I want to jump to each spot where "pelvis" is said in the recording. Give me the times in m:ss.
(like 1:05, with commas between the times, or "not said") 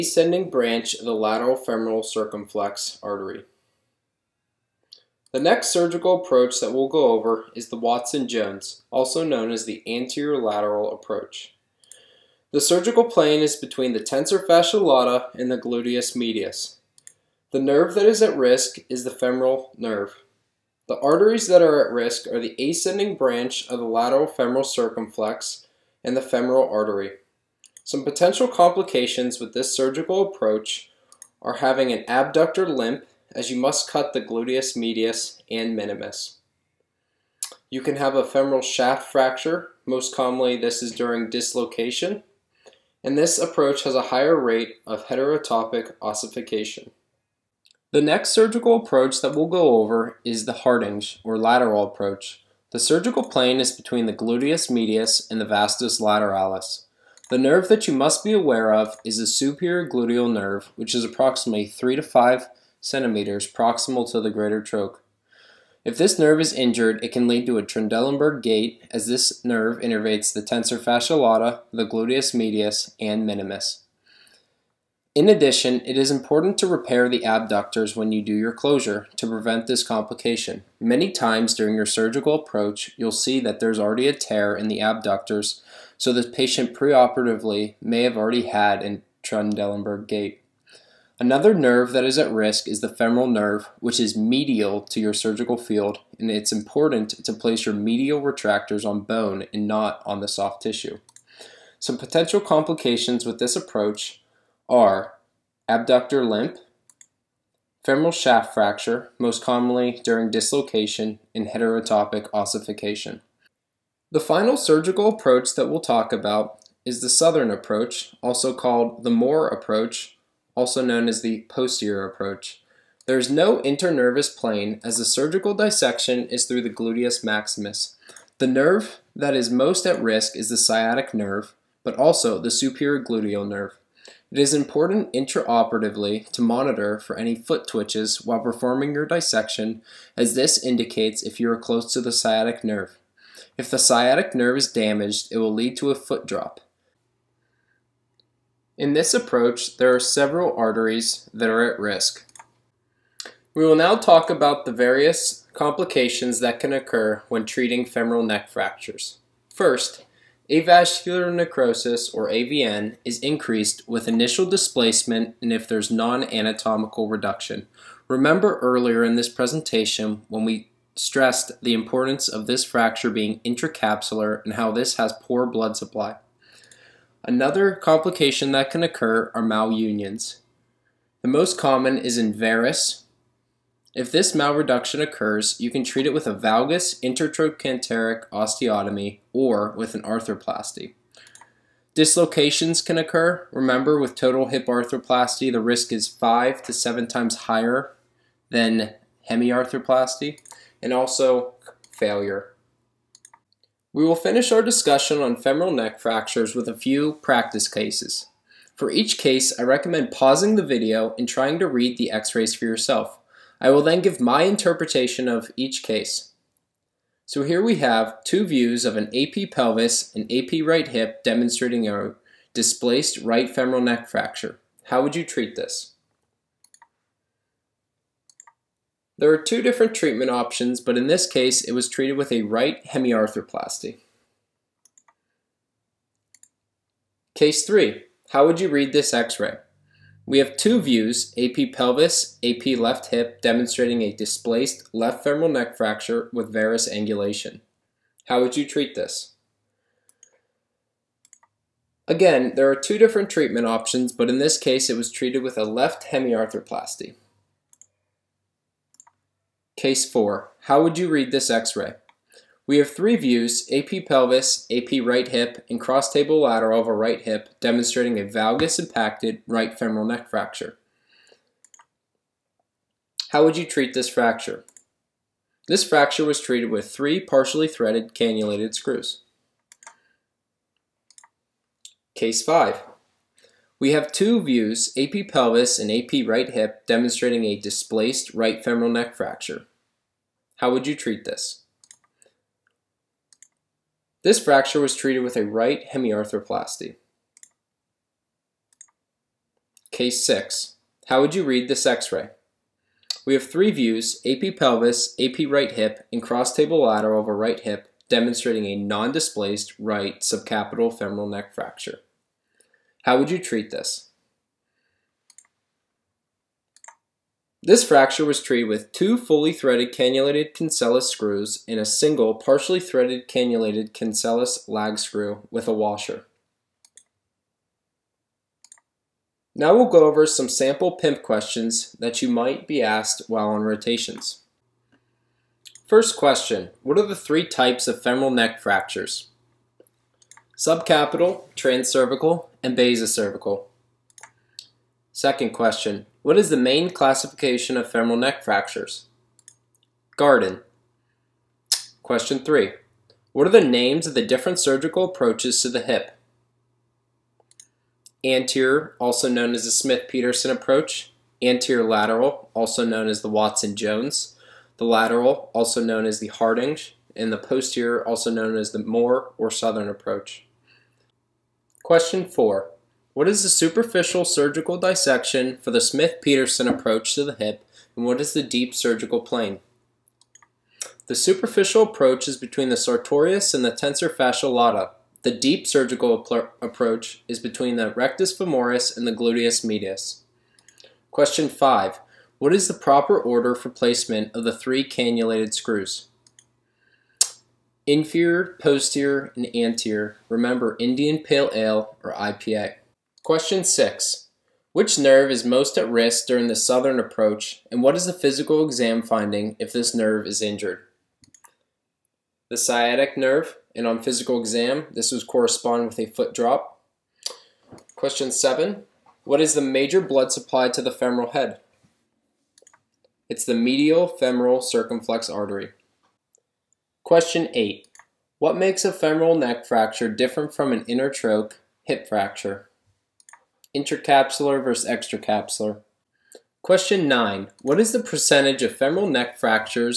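3:39, 4:01, 4:24, 4:45, 5:04.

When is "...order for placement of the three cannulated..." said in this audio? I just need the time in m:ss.
6:33.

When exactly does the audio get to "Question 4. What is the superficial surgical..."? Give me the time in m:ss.
6:11.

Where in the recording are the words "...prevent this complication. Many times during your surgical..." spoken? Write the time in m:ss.
1:19.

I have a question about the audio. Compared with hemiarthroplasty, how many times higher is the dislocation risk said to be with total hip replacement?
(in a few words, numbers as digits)
5 to 7 times.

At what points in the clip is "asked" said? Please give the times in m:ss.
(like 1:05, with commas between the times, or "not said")
5:32.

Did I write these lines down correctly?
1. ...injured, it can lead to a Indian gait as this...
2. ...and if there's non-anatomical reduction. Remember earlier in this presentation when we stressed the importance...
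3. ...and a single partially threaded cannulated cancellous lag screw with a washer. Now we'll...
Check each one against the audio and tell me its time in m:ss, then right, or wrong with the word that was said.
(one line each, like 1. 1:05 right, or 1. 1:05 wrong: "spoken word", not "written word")
1. 1:06 wrong: "Trendelenburg", not "Indian"
2. 2:45 right
3. 5:21 right.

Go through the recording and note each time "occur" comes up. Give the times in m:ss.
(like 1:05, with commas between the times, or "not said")
2:36, 2:58, 3:05, 3:12.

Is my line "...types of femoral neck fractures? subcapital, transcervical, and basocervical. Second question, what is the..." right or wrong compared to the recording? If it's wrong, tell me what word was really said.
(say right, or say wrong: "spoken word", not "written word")
right.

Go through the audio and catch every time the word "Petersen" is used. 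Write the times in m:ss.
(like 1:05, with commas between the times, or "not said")
5:59, 6:15.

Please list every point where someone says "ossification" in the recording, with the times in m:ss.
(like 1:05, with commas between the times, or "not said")
0:46, 1:52.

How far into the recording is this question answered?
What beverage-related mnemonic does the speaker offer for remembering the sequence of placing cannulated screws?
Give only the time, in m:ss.
6:40.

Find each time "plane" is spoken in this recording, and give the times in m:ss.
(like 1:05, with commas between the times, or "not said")
0:13, 0:53, 2:04, 6:19.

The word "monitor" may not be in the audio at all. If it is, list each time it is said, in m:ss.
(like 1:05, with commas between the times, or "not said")
2:16.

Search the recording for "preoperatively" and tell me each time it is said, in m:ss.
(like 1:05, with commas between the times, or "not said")
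1:26.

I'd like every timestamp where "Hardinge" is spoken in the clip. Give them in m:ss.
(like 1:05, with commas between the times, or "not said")
0:50, 6:06.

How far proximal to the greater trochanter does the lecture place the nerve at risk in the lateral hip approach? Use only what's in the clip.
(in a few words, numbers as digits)
3 to 5 centimeters.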